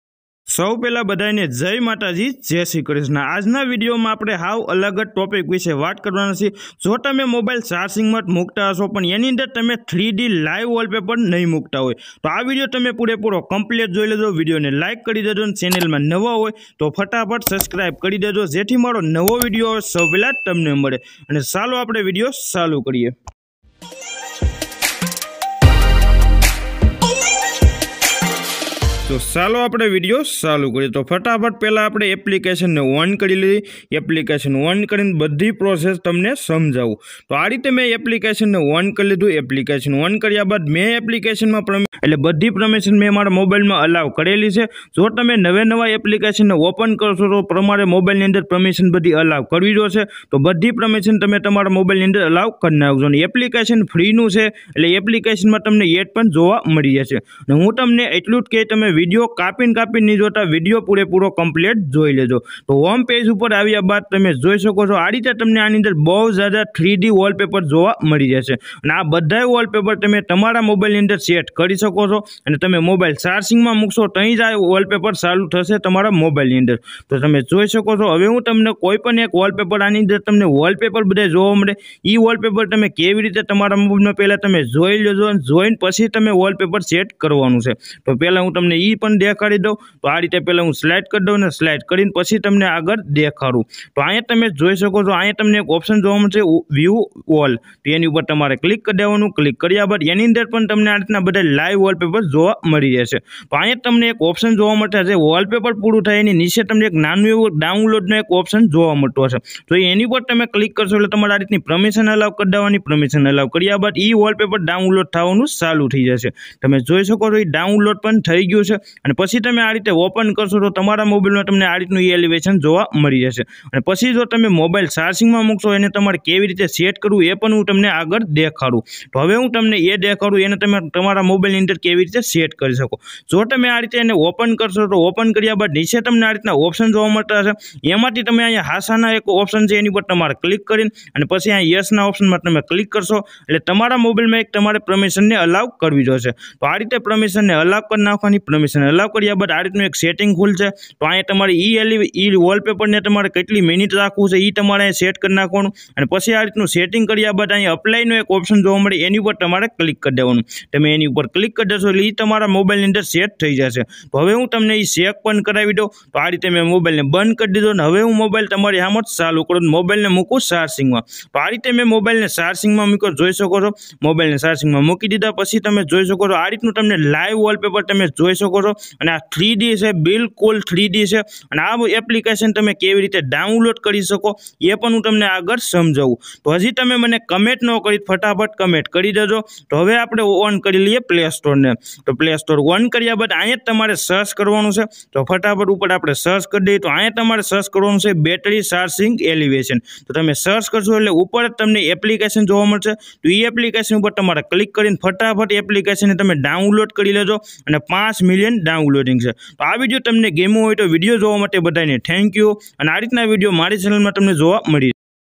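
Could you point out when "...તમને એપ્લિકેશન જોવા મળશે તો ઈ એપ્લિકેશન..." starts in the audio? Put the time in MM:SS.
03:21.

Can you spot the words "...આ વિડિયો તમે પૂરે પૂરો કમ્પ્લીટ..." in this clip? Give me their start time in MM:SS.
00:12.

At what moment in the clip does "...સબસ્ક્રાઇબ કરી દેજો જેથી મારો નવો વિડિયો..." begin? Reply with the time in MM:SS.
00:17.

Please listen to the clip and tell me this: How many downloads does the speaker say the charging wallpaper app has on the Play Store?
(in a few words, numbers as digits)
5 million.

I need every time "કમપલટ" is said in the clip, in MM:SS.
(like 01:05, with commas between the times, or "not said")
00:13, 01:01.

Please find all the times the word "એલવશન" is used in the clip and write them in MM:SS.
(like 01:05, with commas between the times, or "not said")
02:02, 03:19.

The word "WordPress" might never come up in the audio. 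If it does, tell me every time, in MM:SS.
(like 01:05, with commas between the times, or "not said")
not said.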